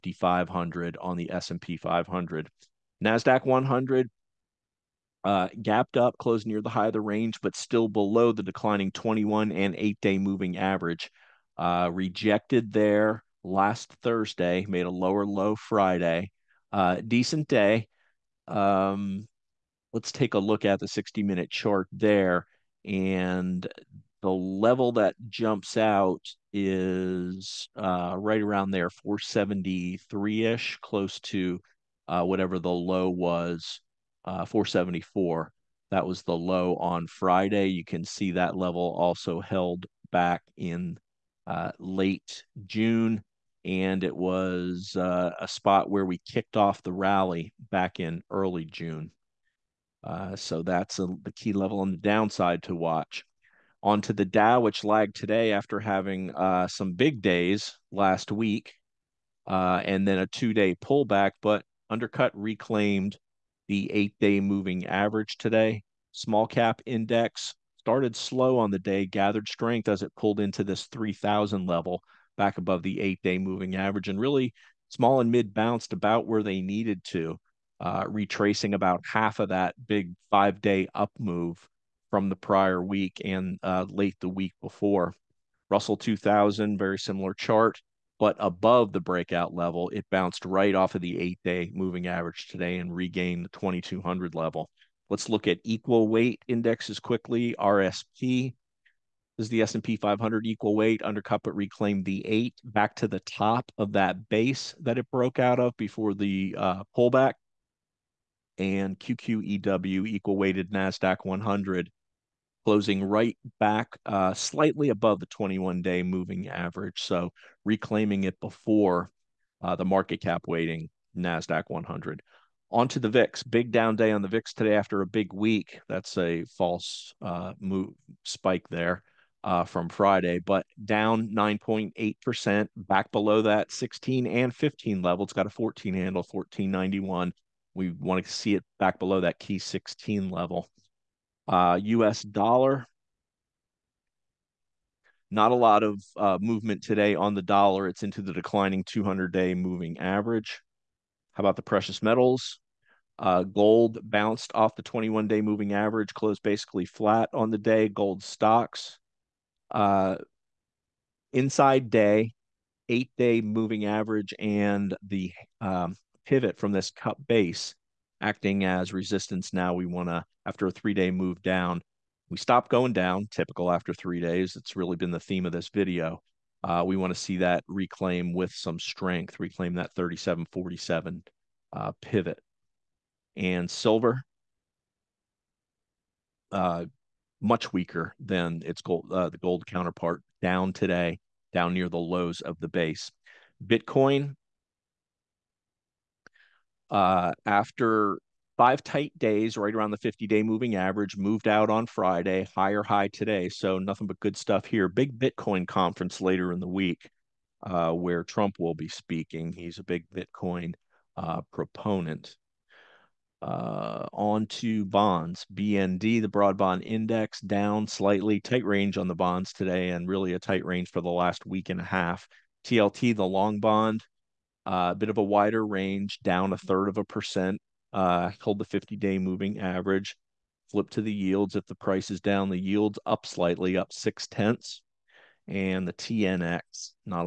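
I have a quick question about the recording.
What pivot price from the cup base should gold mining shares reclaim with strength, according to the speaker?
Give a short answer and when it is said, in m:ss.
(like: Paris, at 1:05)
3747, at 2:59.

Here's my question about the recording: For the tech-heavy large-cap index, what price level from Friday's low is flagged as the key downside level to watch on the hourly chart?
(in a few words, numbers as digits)
474.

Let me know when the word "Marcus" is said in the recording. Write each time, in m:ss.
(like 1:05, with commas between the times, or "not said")
not said.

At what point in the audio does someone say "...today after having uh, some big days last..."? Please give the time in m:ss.
0:55.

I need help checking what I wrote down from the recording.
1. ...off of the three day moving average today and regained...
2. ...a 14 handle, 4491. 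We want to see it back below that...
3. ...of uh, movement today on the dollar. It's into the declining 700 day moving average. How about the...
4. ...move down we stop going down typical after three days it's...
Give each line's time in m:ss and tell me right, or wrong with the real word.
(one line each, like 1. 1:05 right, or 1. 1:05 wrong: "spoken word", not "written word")
1. 1:30 wrong: "eight", not "three"
2. 2:15 wrong: "1491", not "4491"
3. 2:25 wrong: "200", not "700"
4. 2:51 right.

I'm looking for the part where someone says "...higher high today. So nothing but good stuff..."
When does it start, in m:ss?
3:22.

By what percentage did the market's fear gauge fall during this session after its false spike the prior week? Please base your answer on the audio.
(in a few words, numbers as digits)
9.8%.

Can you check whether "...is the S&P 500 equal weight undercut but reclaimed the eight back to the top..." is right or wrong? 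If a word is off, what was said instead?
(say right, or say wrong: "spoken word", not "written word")
right.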